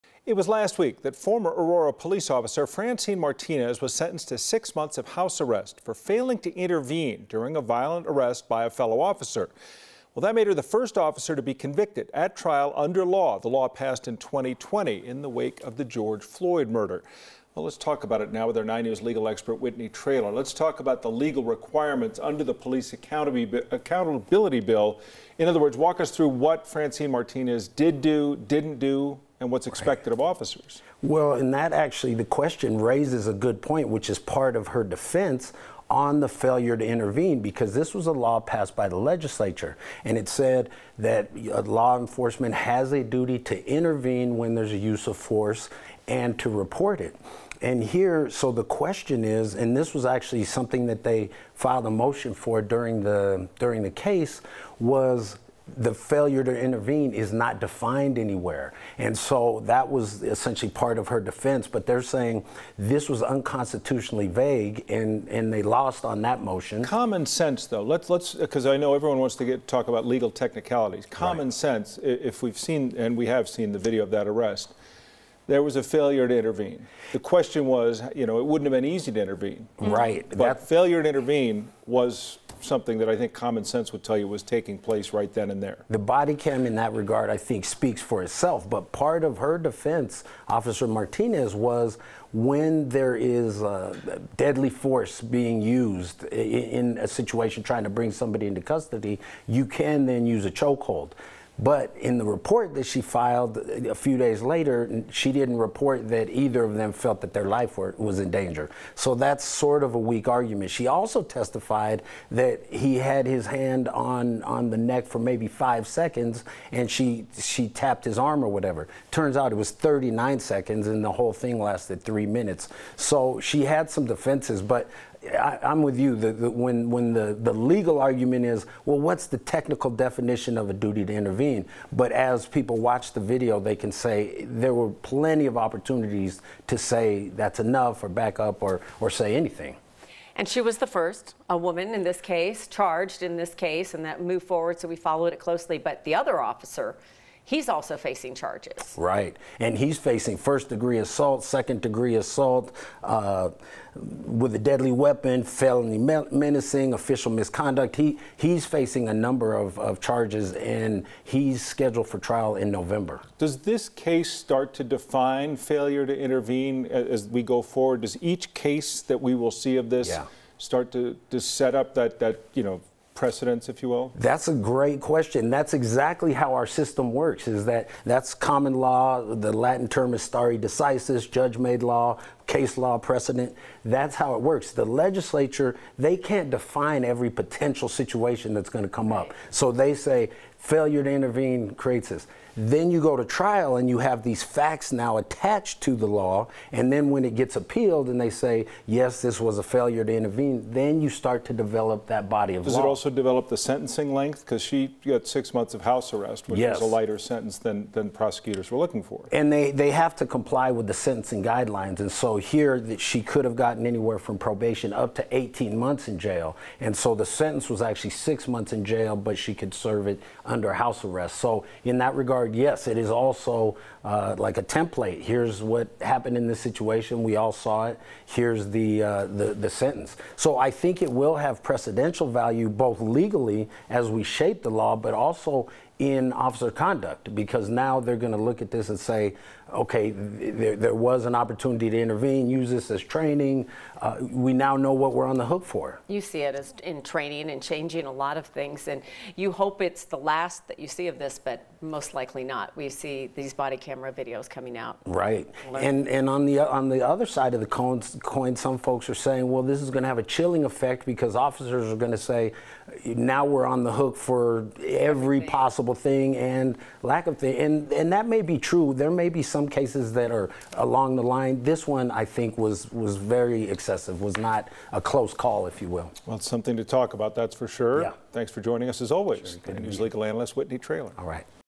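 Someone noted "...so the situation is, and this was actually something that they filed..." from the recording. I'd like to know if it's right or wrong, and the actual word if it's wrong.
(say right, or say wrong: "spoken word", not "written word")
wrong: "question", not "situation".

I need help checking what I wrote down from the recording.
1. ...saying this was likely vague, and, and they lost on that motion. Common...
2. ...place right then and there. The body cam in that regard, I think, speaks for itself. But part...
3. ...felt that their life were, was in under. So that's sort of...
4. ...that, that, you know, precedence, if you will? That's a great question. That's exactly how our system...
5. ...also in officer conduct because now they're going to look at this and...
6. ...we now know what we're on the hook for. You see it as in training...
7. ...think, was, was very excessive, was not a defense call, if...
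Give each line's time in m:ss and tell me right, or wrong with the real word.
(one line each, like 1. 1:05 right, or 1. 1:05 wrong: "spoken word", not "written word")
1. 1:02 wrong: "unconstitutionally", not "likely"
2. 1:24 right
3. 1:46 wrong: "danger", not "under"
4. 2:51 right
5. 3:55 right
6. 4:04 right
7. 4:32 wrong: "close", not "defense".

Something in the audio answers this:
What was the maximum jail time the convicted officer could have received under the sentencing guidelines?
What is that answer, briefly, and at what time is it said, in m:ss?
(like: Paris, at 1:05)
18 months, at 3:35.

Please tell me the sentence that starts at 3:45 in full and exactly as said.
Here's what happened in this situation.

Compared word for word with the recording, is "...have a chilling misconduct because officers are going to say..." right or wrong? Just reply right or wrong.
wrong.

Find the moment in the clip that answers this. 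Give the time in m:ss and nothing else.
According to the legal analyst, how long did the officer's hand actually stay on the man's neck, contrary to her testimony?
1:59.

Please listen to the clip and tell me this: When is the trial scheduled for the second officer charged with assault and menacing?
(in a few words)
November.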